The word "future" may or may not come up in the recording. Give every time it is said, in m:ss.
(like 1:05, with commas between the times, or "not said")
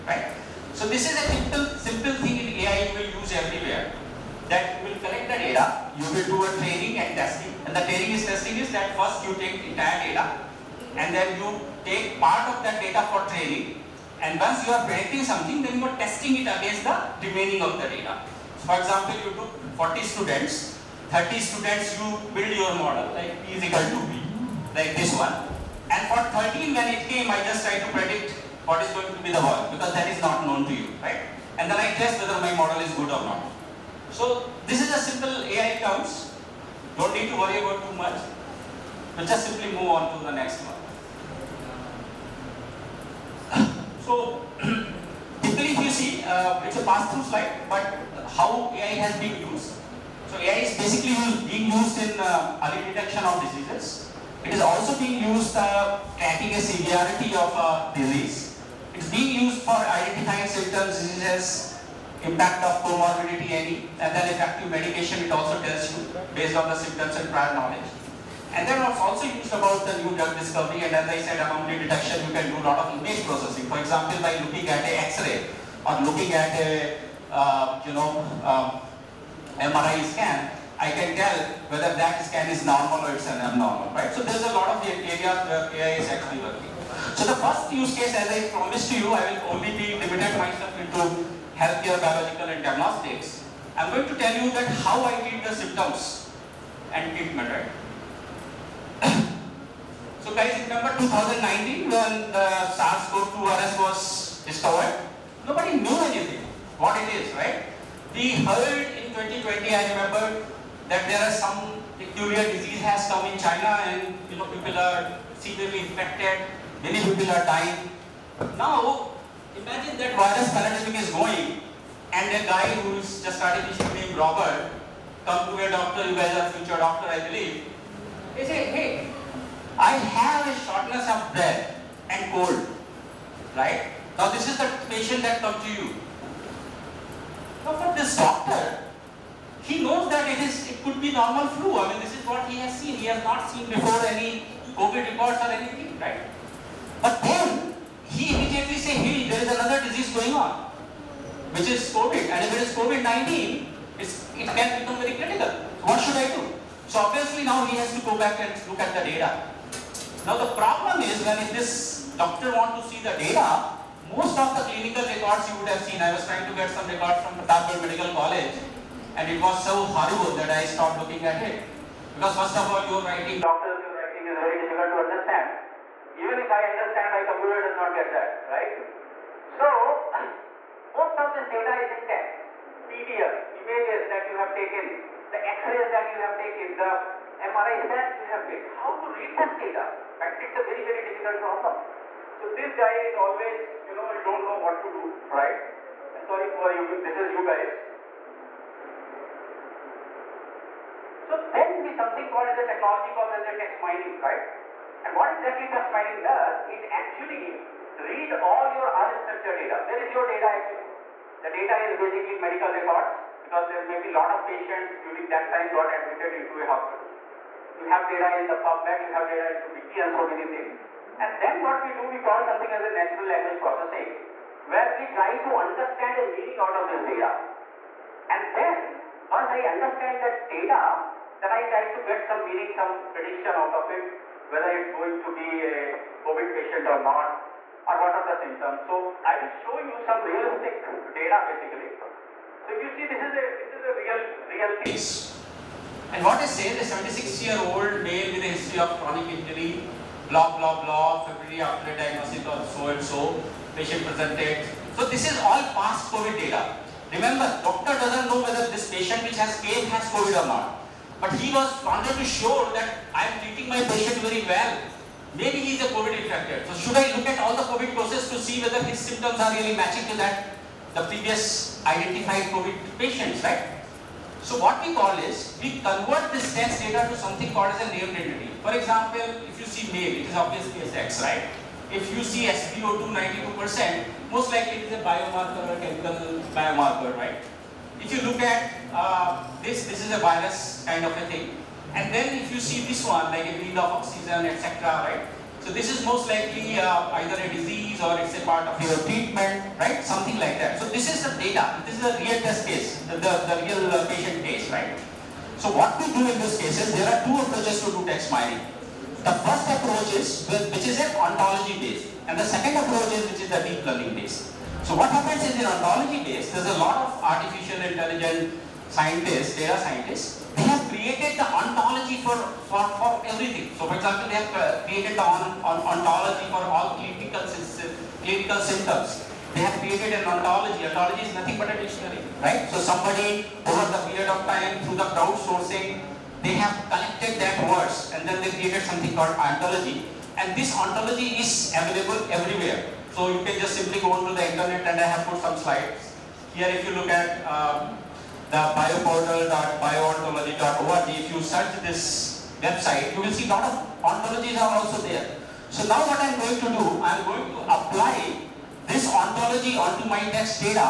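2:06.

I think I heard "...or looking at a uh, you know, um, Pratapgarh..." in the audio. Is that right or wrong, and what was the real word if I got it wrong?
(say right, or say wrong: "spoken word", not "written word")
wrong: "MRI", not "Pratapgarh".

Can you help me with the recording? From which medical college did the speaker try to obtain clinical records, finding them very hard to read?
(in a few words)
Pratapgarh Medical College.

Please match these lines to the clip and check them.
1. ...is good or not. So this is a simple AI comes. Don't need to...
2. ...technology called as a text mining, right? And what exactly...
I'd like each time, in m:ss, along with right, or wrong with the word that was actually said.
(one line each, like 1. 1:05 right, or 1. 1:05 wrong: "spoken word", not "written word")
1. 0:32 right
2. 3:22 right.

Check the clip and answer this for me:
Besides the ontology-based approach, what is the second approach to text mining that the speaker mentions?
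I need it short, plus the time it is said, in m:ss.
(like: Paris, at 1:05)
Deep learning based, at 5:13.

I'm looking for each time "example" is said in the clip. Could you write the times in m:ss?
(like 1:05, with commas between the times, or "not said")
0:18, 1:13, 4:38, 5:23.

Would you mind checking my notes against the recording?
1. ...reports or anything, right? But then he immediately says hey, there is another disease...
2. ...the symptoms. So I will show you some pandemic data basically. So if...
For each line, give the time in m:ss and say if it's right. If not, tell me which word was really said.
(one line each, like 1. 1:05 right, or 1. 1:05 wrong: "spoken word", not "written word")
1. 2:25 right
2. 3:58 wrong: "realistic", not "pandemic".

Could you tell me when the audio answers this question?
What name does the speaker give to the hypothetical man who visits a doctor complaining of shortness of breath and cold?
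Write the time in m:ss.
2:04.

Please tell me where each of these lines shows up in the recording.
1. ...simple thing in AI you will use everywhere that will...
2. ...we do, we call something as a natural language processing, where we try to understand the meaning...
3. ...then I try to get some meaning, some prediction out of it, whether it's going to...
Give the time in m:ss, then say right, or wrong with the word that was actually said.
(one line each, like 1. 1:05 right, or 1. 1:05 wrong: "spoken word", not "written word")
1. 0:01 right
2. 3:41 right
3. 3:51 right.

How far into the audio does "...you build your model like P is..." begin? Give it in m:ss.
0:21.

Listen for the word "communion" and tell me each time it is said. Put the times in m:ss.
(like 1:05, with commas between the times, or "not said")
not said.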